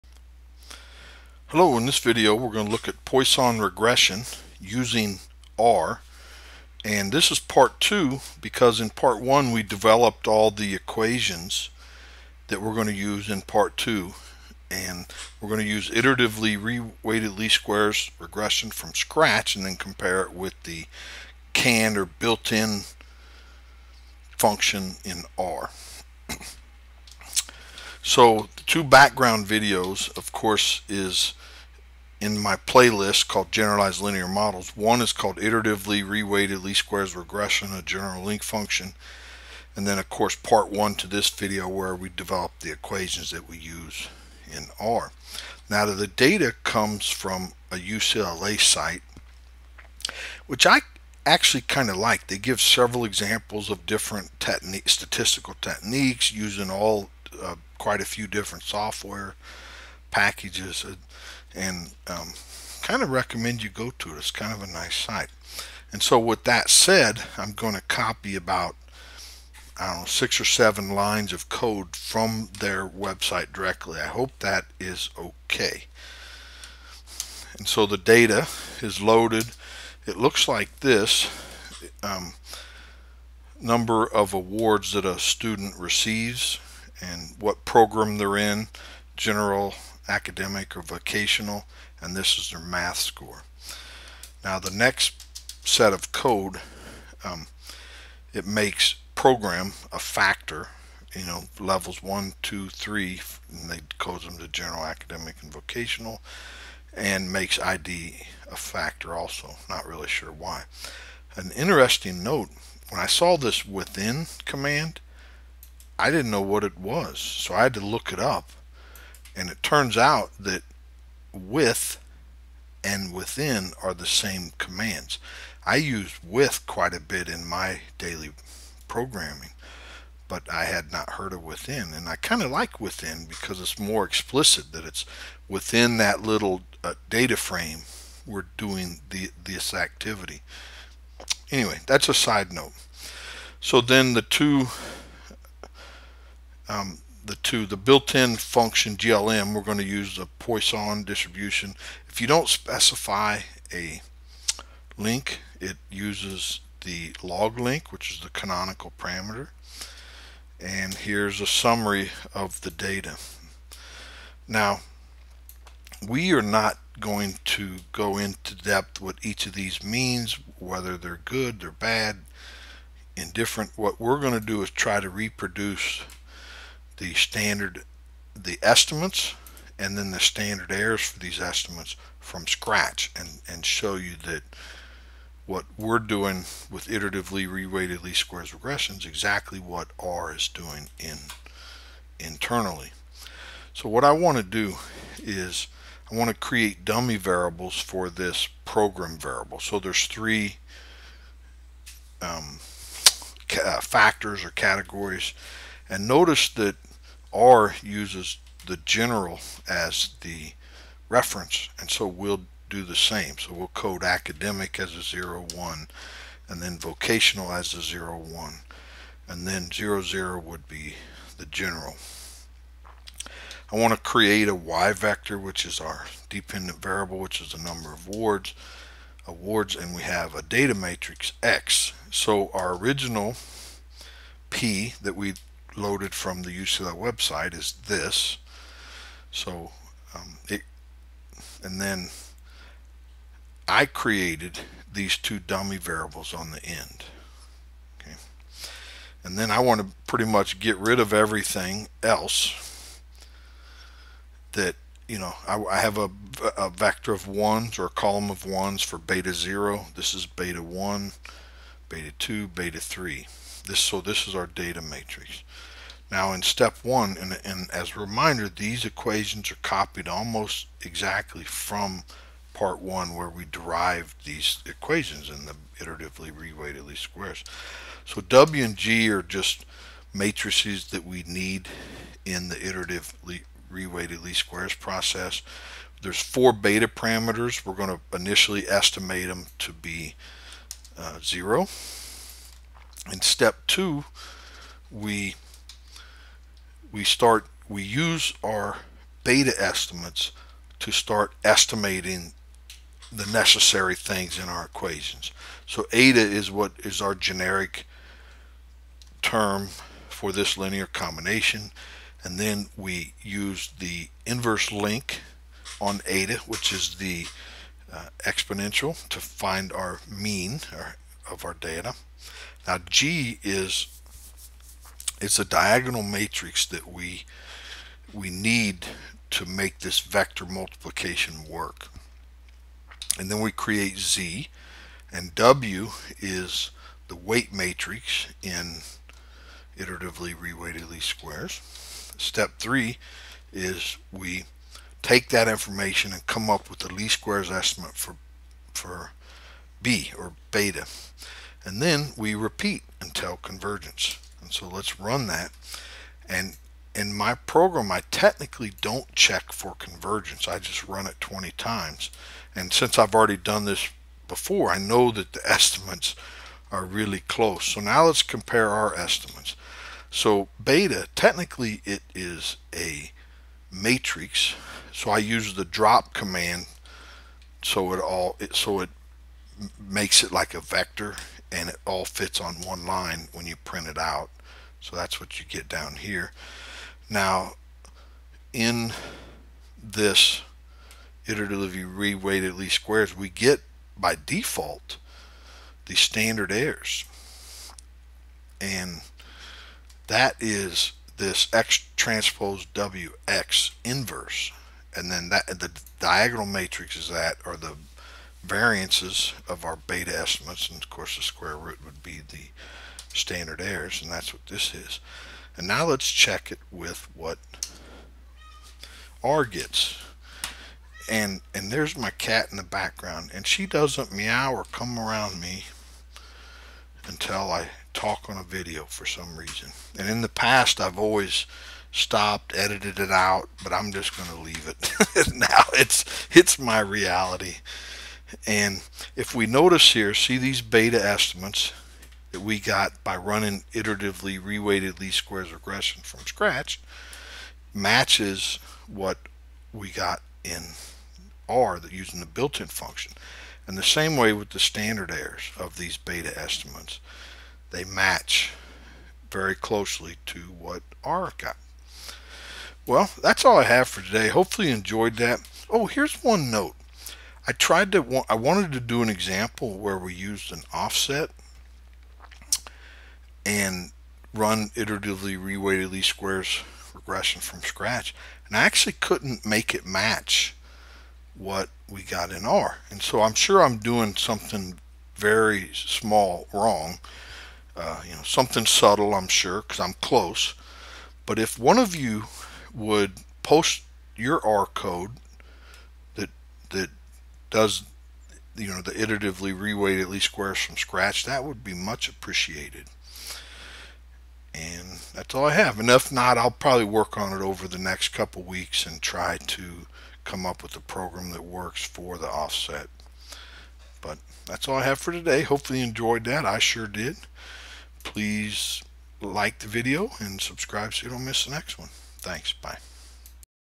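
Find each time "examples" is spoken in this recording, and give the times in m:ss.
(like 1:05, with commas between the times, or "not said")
0:53, 7:49.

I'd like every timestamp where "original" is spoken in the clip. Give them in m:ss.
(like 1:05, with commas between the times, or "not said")
3:52.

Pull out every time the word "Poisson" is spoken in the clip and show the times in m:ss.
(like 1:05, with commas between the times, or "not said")
0:03, 2:30.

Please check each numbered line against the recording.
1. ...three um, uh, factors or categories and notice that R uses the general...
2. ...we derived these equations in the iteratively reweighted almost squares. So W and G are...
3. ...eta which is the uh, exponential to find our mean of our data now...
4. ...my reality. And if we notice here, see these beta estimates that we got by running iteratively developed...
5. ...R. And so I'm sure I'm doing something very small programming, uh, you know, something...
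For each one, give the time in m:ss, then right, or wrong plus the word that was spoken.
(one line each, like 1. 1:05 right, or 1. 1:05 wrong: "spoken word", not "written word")
1. 3:20 right
2. 4:33 wrong: "least", not "almost"
3. 5:16 right
4. 7:16 wrong: "reweighted", not "developed"
5. 8:02 wrong: "wrong", not "programming".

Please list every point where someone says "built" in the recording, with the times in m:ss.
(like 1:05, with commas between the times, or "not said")
0:22, 2:27, 7:32.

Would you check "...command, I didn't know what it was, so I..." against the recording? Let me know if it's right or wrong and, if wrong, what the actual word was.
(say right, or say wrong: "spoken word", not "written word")
right.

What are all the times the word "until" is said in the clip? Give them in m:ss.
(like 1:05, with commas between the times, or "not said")
5:52, 7:07.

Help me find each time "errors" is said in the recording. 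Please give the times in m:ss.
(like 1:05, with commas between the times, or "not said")
3:00, 6:36, 6:53, 7:35.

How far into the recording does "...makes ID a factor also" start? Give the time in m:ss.
1:47.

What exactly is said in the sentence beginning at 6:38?
And that is this X transpose WX inverse.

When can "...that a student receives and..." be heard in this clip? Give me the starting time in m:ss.
1:24.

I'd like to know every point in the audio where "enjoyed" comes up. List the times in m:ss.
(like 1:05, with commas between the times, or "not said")
7:44, 8:35.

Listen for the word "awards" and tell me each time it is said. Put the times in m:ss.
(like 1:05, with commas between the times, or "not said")
1:24, 3:49.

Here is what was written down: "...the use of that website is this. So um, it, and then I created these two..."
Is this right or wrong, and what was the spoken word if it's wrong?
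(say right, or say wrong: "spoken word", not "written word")
right.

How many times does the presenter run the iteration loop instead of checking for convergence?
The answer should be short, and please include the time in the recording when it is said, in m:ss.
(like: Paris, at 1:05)
20, at 6:01.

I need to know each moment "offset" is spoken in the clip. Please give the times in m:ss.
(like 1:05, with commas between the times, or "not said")
7:50, 8:32.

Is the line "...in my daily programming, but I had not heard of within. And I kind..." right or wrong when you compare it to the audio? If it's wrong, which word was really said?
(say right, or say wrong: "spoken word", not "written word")
right.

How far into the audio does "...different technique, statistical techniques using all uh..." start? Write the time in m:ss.
0:53.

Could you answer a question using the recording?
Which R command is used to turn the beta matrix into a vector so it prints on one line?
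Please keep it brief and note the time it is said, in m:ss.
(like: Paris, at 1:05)
drop, at 6:15.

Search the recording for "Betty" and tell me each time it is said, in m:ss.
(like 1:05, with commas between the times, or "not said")
not said.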